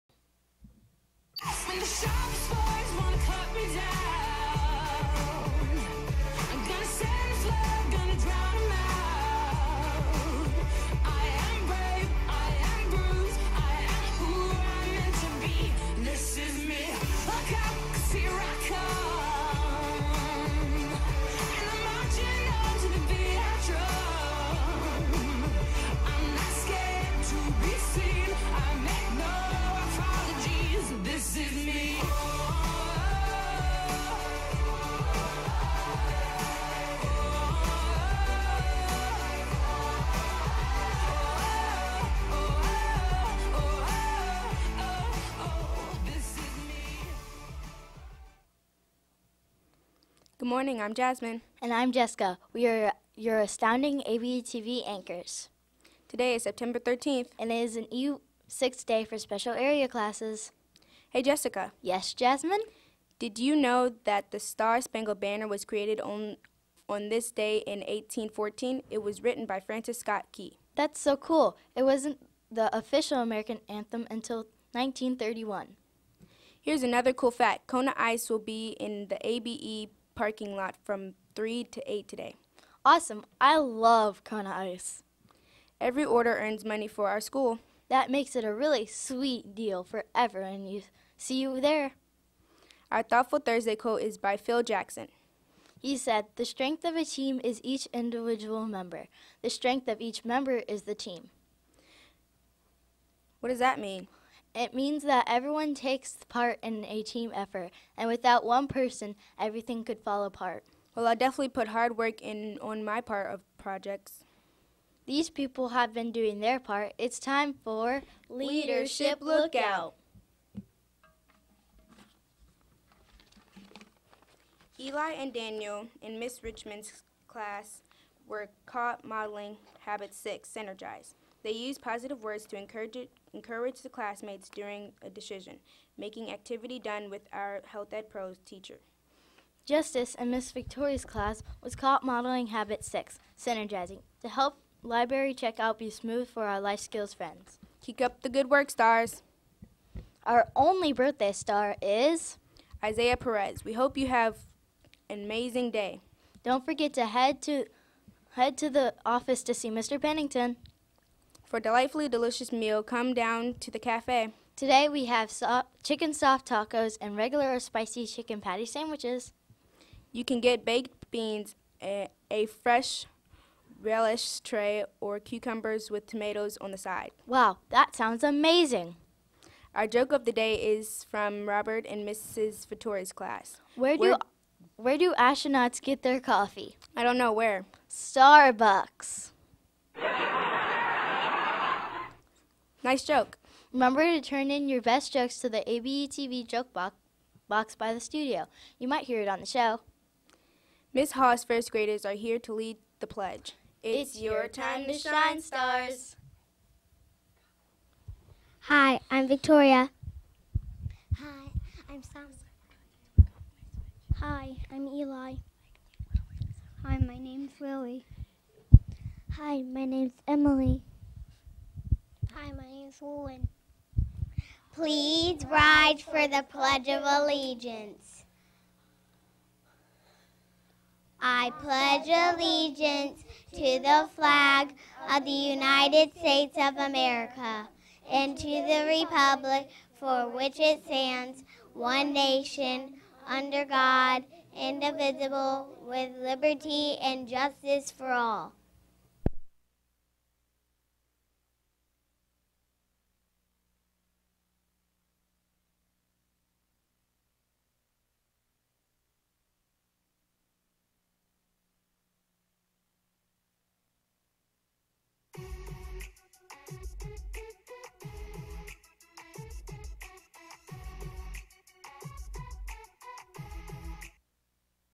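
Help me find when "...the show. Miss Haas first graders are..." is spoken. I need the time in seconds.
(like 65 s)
199 s.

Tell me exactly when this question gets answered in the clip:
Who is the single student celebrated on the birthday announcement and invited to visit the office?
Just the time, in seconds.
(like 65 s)
152 s.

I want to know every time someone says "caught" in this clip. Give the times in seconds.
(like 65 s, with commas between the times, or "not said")
128 s, 141 s.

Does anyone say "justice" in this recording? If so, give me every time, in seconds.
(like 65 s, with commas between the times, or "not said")
139 s, 247 s.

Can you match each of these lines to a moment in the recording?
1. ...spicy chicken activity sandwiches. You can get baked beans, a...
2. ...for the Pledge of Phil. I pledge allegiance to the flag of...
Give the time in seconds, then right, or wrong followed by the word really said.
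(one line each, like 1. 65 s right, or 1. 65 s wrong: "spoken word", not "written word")
1. 167 s wrong: "patty", not "activity"
2. 225 s wrong: "Allegiance", not "Phil".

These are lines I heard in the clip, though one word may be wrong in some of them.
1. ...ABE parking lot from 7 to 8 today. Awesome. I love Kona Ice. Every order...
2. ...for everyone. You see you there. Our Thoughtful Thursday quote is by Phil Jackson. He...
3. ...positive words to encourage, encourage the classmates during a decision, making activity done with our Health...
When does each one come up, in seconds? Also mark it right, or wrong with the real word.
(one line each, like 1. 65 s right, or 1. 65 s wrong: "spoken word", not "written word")
1. 79 s wrong: "3", not "7"
2. 89 s right
3. 131 s right.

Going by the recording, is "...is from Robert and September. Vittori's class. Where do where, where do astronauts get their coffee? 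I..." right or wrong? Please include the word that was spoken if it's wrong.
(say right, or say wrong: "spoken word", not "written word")
wrong: "Mrs", not "September".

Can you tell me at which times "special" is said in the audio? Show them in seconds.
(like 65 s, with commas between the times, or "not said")
59 s.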